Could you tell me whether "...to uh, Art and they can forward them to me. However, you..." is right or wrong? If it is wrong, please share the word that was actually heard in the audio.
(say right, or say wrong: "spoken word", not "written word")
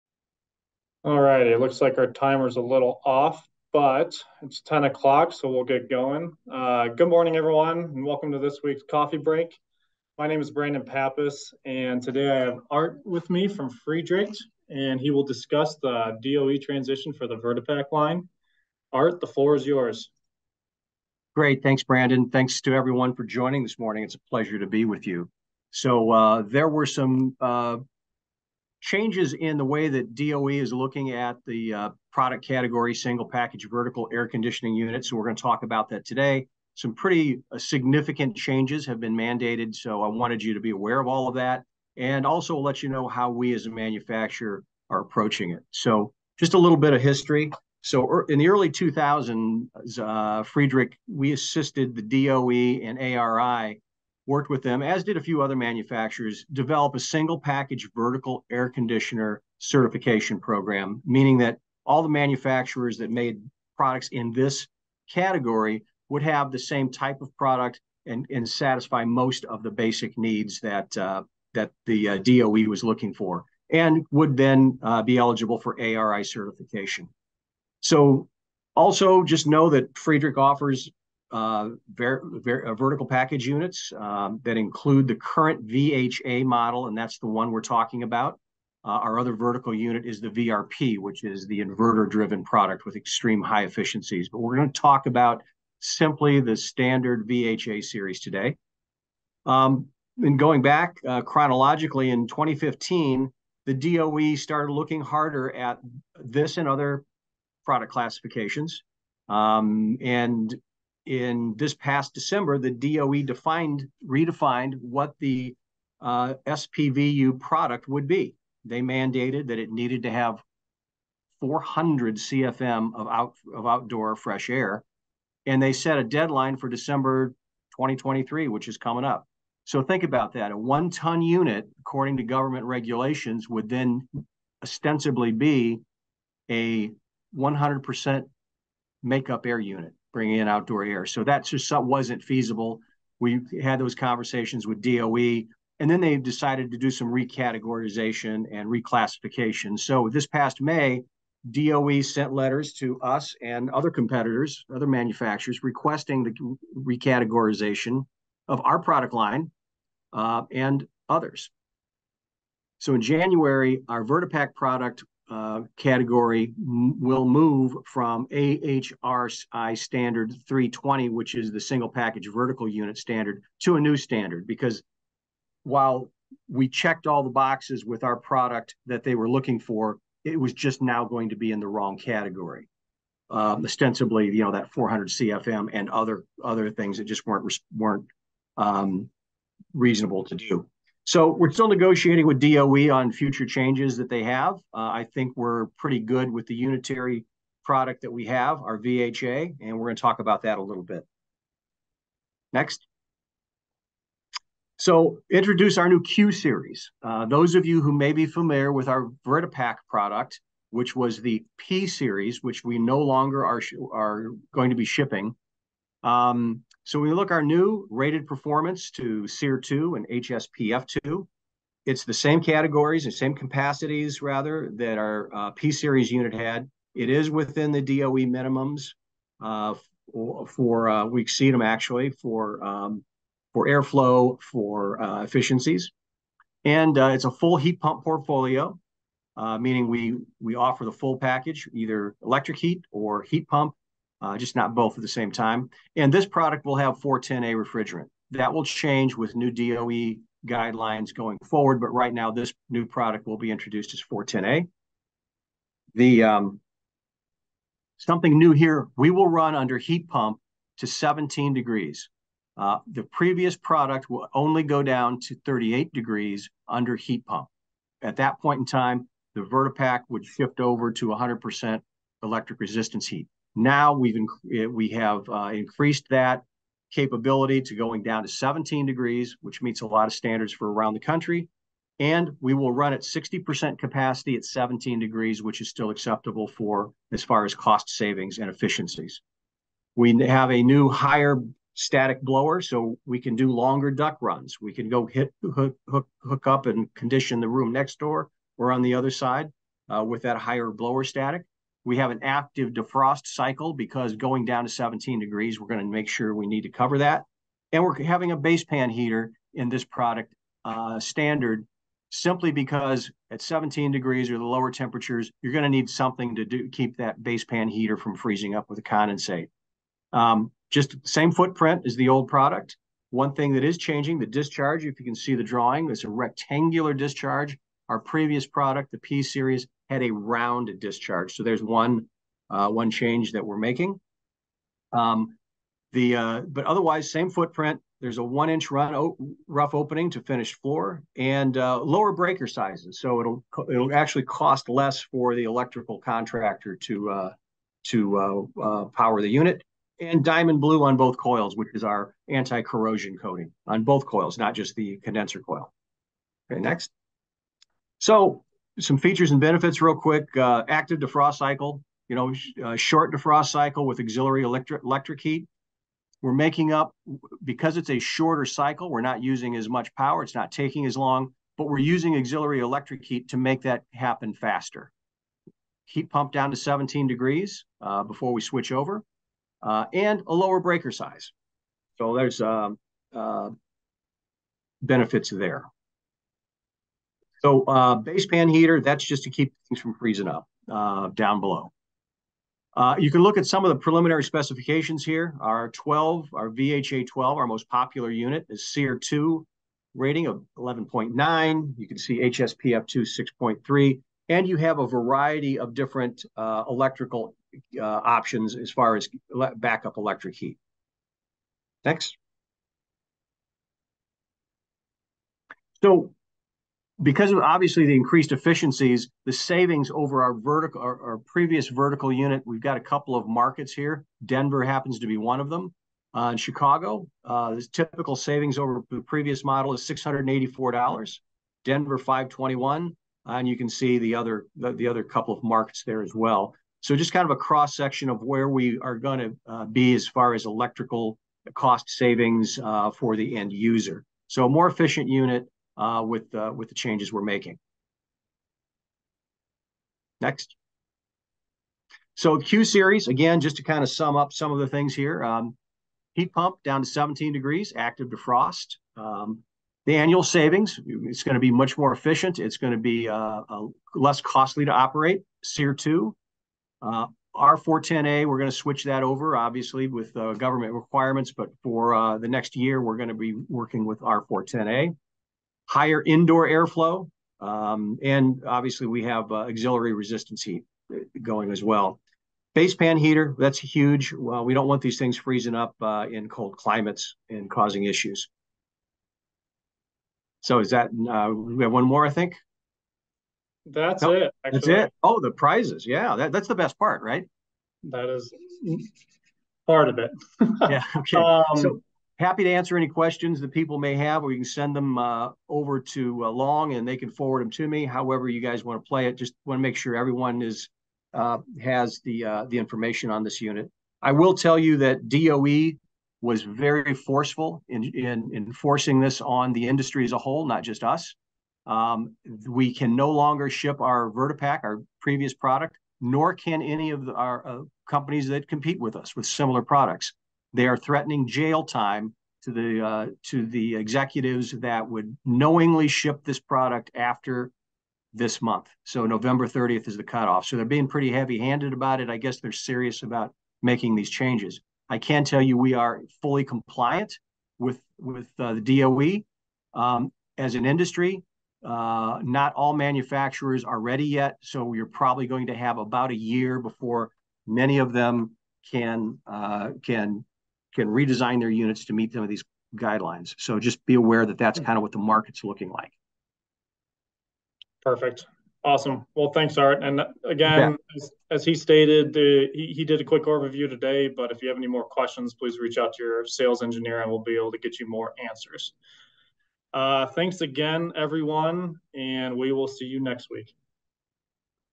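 wrong: "Long", not "Art".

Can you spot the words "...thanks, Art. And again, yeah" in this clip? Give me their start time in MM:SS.
09:29.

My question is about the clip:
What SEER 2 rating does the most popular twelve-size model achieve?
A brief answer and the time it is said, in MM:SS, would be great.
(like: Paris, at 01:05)
11.9, at 06:40.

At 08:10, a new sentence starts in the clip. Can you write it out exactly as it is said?
So is that, uh, we have one more, I think?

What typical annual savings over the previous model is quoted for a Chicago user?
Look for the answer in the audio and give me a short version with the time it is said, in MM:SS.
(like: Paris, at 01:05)
$684, at 07:09.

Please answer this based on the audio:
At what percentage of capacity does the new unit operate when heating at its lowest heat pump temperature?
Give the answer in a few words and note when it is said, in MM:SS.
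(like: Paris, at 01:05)
60%, at 04:43.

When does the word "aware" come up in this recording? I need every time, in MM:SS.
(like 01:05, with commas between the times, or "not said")
00:40, 09:23.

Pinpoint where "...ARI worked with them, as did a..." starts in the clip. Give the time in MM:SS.
00:52.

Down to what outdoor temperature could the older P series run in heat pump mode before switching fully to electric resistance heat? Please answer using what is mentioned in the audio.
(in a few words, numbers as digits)
38 degrees.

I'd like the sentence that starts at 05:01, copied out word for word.
We have an active defrost cycle because going down to 17 degrees, we're going to make sure we need to cover that.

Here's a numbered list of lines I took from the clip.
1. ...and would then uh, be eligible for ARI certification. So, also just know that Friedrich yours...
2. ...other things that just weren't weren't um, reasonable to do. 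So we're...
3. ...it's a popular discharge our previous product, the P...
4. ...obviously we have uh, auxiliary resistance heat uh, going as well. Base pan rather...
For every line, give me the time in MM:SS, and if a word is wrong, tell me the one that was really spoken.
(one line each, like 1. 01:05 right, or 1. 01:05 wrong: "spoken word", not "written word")
1. 01:13 wrong: "offers", not "yours"
2. 03:06 right
3. 05:25 wrong: "rectangular", not "popular"
4. 07:58 wrong: "heater", not "rather".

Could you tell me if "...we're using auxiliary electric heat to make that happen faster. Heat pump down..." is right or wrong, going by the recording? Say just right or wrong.
right.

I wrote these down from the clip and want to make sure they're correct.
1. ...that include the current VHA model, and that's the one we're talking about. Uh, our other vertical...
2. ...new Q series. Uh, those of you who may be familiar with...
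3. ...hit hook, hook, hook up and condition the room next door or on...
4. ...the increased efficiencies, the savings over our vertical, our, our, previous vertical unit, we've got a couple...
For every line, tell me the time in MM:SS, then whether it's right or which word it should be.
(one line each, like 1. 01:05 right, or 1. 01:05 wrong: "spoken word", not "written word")
1. 01:24 right
2. 03:25 right
3. 04:55 right
4. 06:57 right.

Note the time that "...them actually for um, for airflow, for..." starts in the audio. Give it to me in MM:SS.
03:51.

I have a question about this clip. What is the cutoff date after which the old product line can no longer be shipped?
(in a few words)
November 30th.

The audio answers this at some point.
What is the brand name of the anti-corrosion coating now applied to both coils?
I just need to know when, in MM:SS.
05:50.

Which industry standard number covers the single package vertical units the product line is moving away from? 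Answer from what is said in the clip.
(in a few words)
AHRI 320.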